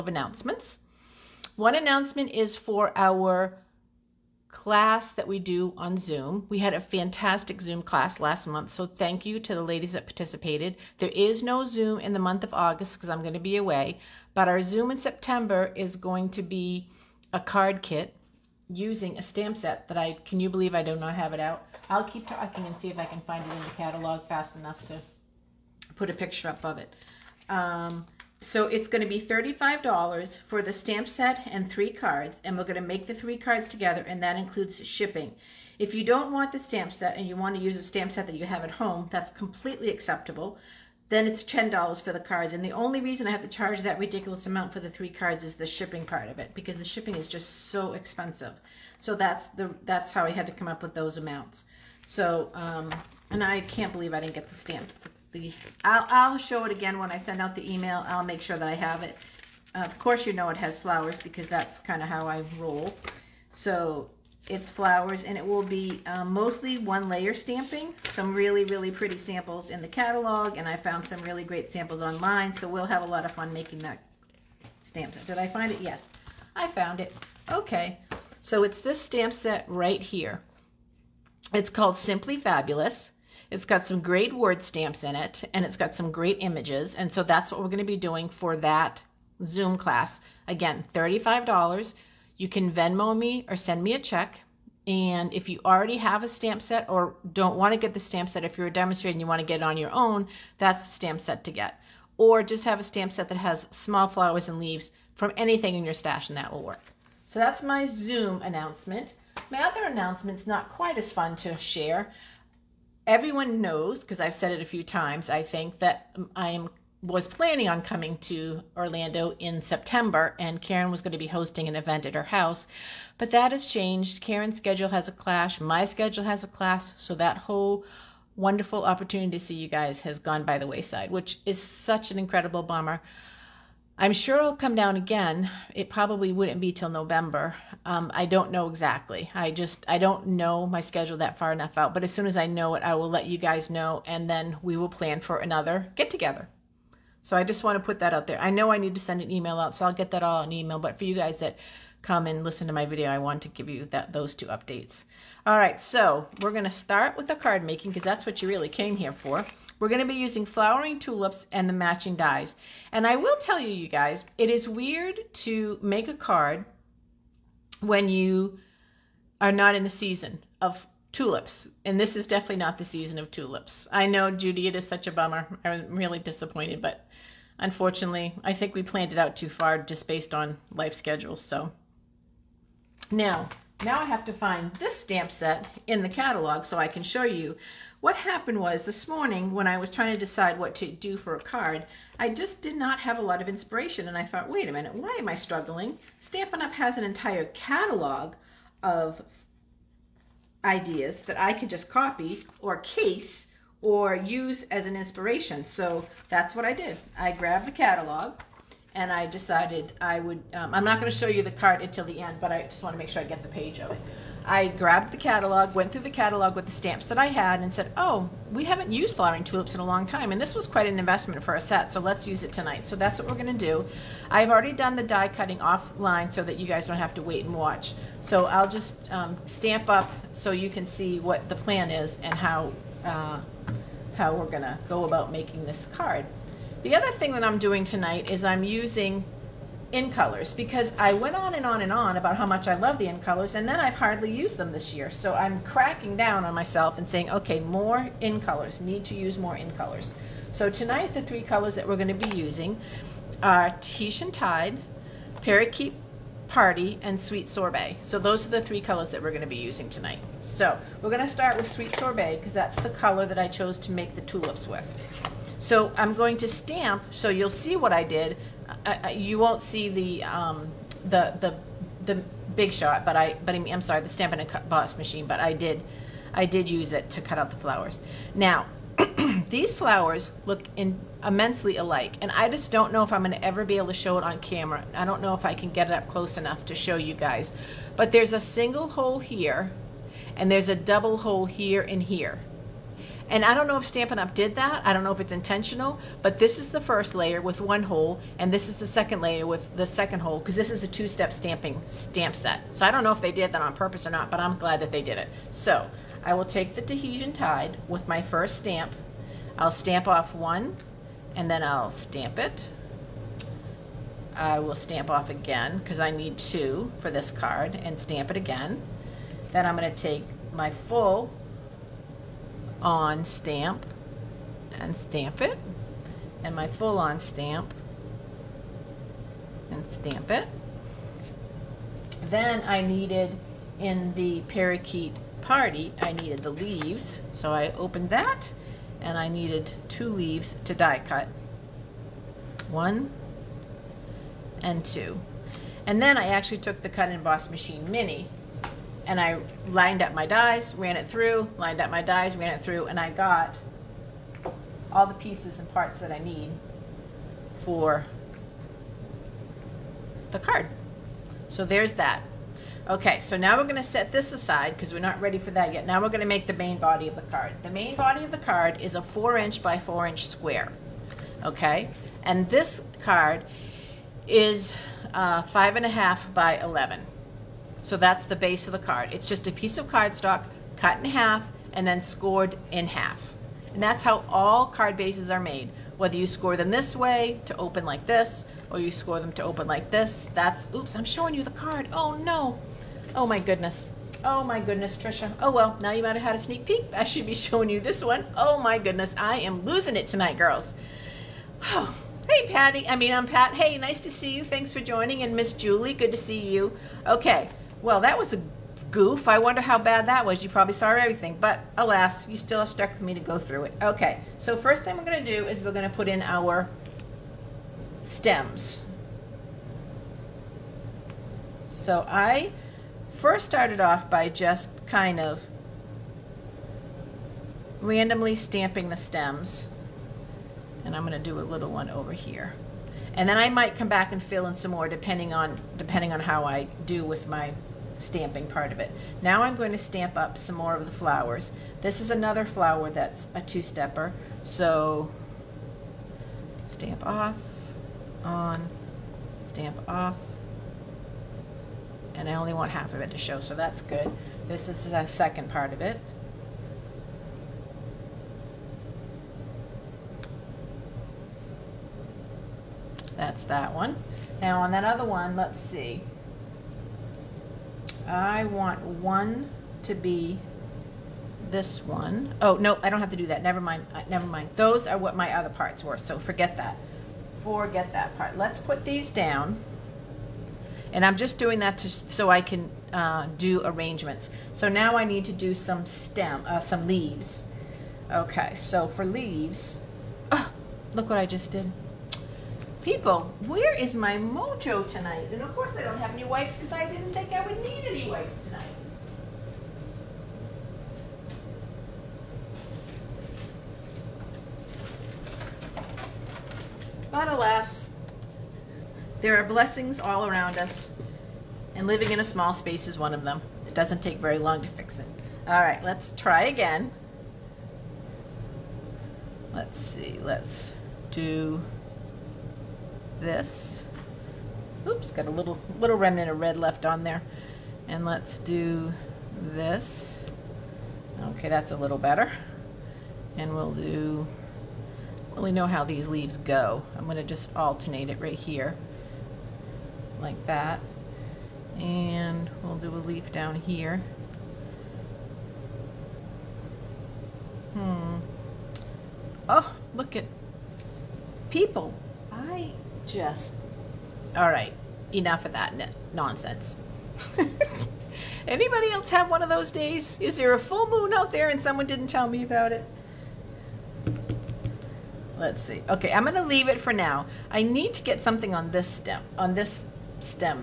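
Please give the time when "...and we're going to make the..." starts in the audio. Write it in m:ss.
0:32.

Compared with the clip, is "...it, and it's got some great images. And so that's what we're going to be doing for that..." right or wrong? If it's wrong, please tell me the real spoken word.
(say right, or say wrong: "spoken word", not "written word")
right.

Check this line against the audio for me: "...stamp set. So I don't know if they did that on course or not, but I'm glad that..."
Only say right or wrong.
wrong.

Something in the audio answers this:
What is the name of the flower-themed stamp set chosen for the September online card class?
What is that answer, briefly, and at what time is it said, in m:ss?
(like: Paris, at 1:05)
Simply Fabulous, at 1:21.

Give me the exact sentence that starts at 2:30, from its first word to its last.
But for you guys that come and listen to my video, I want to give you that those two updates.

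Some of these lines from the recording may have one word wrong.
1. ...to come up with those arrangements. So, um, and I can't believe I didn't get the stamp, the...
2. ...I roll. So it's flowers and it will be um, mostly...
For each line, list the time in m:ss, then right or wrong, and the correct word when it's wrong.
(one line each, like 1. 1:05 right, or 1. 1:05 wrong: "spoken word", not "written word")
1. 0:50 wrong: "amounts", not "arrangements"
2. 1:02 right.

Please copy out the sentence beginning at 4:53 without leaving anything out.
And I don't know if Stampin' Up!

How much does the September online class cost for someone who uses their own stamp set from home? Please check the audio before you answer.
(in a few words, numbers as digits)
$10.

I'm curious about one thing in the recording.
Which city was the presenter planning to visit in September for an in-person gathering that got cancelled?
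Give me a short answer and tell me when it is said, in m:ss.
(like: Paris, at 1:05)
Orlando, at 1:58.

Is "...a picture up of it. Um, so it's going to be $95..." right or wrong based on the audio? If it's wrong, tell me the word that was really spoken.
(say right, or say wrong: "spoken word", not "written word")
wrong: "35", not "95".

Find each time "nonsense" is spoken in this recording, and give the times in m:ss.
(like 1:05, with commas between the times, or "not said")
9:16.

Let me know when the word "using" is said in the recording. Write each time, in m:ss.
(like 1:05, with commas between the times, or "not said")
0:18, 2:40, 3:58, 4:12, 4:19.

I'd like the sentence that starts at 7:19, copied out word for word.
Now I'm going to stamp up some more of the flowers.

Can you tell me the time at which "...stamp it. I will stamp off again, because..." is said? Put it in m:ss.
5:11.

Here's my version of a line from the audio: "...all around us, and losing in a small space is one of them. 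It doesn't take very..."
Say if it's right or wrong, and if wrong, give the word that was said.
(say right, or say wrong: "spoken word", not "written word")
wrong: "living", not "losing".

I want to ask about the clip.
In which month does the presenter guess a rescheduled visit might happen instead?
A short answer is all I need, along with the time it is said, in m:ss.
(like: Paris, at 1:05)
November, at 2:16.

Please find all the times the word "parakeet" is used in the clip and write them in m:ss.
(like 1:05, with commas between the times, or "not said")
4:15, 5:34.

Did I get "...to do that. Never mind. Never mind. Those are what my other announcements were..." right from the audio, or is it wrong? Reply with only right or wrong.
wrong.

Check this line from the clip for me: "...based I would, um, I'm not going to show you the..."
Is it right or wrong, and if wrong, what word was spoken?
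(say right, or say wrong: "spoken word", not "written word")
wrong: "decided", not "based".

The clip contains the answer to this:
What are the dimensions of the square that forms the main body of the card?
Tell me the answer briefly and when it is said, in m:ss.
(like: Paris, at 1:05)
4 inches by 4 inches, at 6:09.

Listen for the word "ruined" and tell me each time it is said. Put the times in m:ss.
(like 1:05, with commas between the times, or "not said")
not said.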